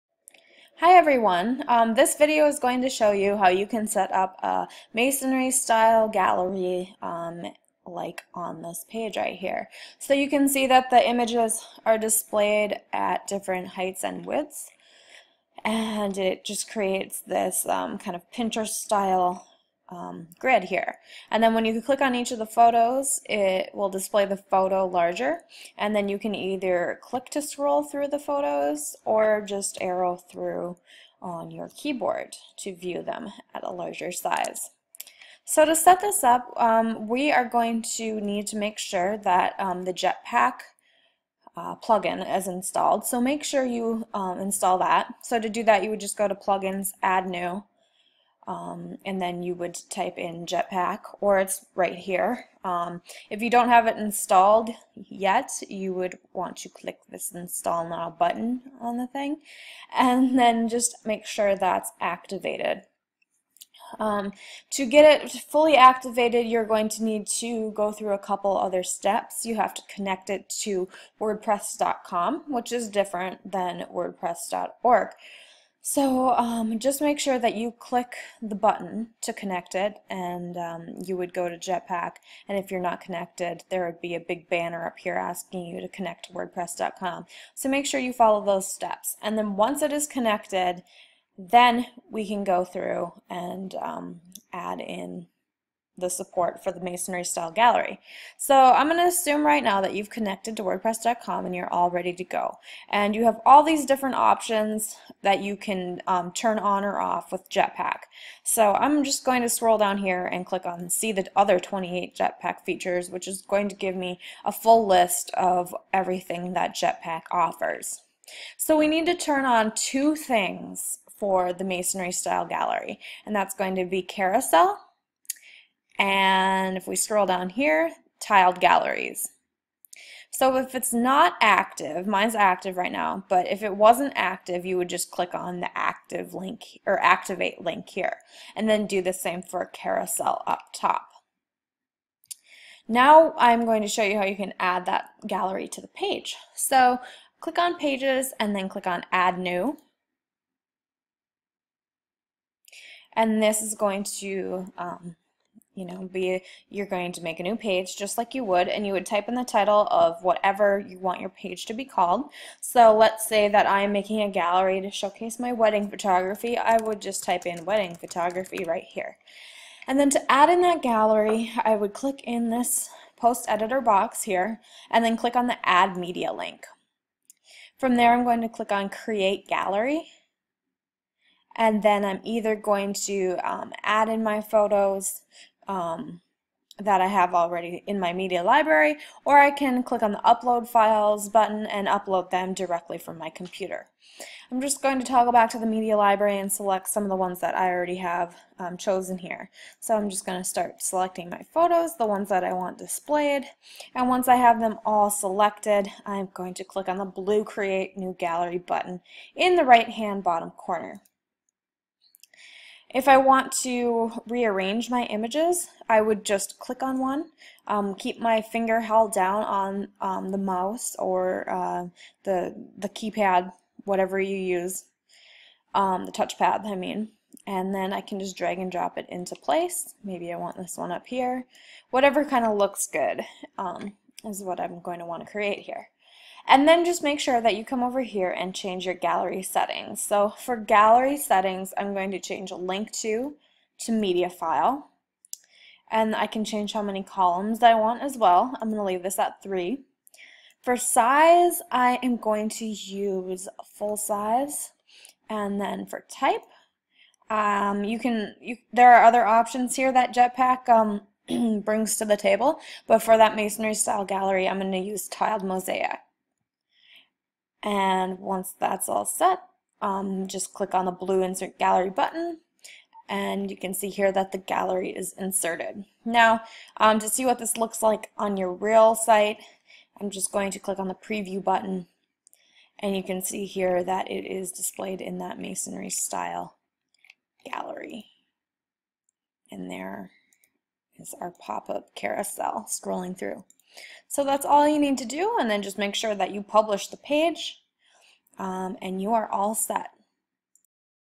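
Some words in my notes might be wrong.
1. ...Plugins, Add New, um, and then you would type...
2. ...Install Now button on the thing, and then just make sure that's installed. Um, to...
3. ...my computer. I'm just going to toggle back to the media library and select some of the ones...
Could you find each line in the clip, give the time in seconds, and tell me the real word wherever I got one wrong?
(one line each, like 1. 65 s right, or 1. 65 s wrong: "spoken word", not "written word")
1. 46 s right
2. 57 s wrong: "activated", not "installed"
3. 193 s right.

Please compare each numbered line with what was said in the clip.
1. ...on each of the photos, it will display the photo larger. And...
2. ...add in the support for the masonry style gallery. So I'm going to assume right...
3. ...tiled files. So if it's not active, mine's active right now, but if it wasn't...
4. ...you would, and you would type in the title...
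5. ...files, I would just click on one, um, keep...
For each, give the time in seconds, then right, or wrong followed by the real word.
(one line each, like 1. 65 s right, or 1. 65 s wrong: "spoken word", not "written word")
1. 22 s right
2. 94 s right
3. 128 s wrong: "galleries", not "files"
4. 158 s right
5. 215 s wrong: "images", not "files".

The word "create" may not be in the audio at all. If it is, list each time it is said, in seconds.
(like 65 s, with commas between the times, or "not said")
16 s, 178 s, 207 s, 235 s.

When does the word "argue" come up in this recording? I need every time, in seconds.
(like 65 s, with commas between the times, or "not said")
not said.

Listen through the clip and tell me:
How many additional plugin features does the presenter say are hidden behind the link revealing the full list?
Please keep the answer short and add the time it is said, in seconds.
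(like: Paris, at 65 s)
28, at 111 s.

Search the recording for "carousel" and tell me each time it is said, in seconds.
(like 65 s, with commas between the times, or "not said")
124 s, 139 s, 291 s.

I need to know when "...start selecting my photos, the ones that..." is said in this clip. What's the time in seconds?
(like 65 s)
200 s.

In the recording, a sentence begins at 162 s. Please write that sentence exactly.
So let's say that I'm making a gallery to showcase my wedding photography.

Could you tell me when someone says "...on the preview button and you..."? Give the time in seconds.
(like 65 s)
280 s.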